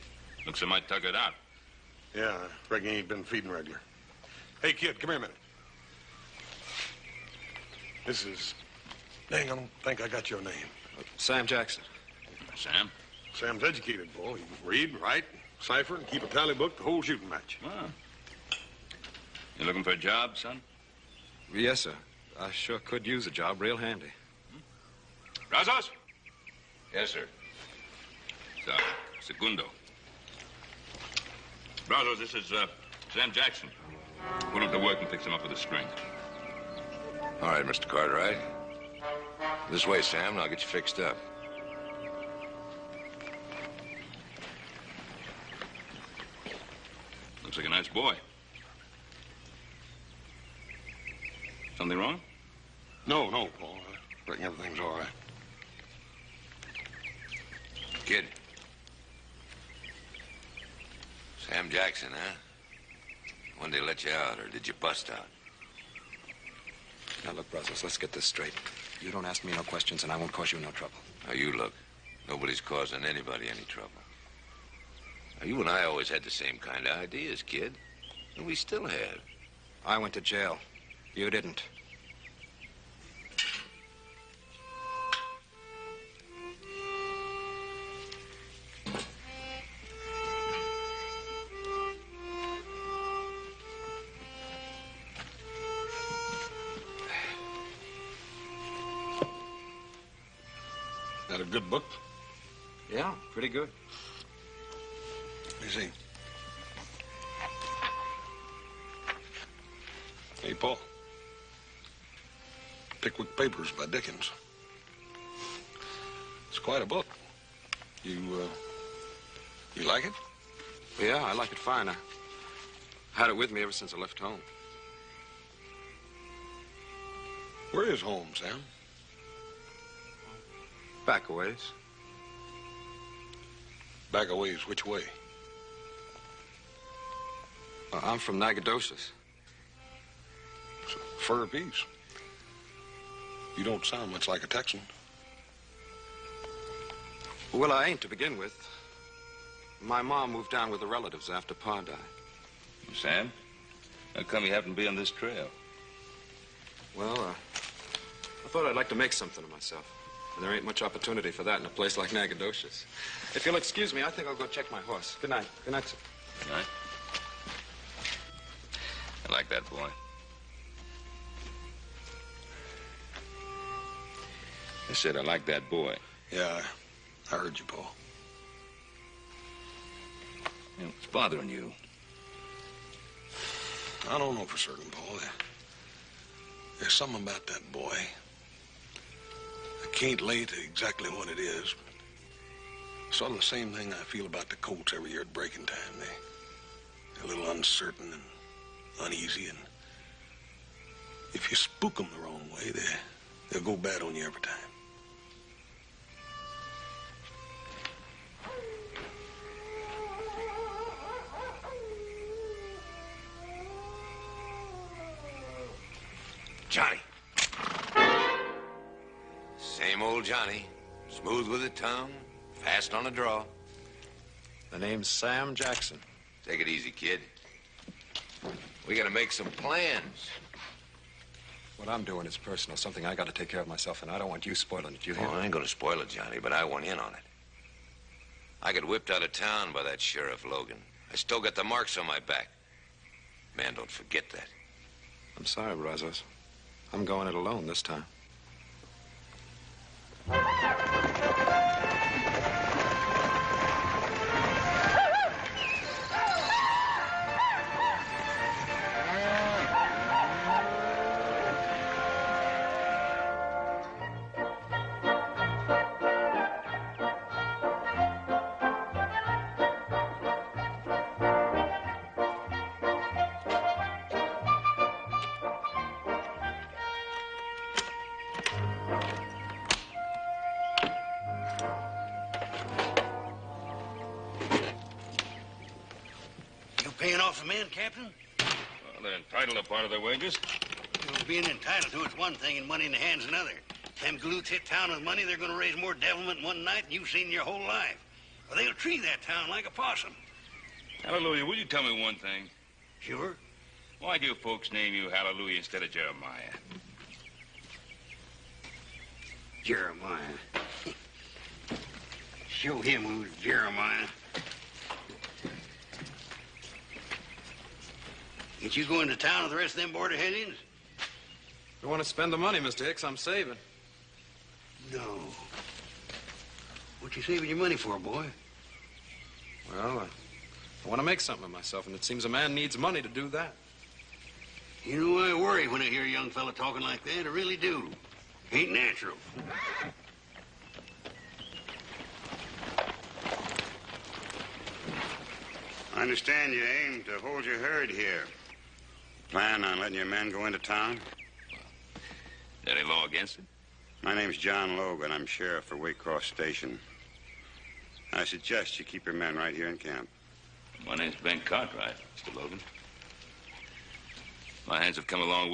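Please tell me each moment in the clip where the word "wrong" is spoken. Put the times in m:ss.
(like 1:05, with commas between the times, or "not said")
0:51, 3:22.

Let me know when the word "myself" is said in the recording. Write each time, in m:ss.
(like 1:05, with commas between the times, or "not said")
2:39, 3:53, 5:31.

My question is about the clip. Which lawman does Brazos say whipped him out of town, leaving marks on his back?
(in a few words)
Sheriff Logan.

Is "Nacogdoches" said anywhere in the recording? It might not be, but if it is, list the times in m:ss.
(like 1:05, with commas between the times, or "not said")
2:18, 2:42.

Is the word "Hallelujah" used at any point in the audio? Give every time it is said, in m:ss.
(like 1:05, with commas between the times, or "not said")
5:01, 5:05.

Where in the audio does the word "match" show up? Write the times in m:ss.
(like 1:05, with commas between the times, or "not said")
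0:17.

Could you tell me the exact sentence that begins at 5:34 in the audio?
You know, I worry when I hear a young fella talking like that.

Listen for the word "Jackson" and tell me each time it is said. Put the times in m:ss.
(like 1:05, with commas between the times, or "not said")
0:11, 0:33, 1:01, 3:45.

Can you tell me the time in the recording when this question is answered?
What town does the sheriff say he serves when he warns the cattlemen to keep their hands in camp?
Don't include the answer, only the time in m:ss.
5:55.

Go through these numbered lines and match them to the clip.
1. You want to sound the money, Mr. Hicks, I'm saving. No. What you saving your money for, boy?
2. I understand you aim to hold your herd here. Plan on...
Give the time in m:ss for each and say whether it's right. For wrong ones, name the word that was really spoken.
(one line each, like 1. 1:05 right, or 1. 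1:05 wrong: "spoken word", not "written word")
1. 5:21 wrong: "spend", not "sound"
2. 5:45 right.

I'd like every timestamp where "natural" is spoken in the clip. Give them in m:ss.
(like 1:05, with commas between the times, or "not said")
5:38.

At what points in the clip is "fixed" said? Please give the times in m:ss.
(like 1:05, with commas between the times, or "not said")
0:35, 0:40.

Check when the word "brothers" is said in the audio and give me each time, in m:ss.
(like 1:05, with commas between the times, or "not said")
1:07.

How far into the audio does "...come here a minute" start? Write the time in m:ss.
0:04.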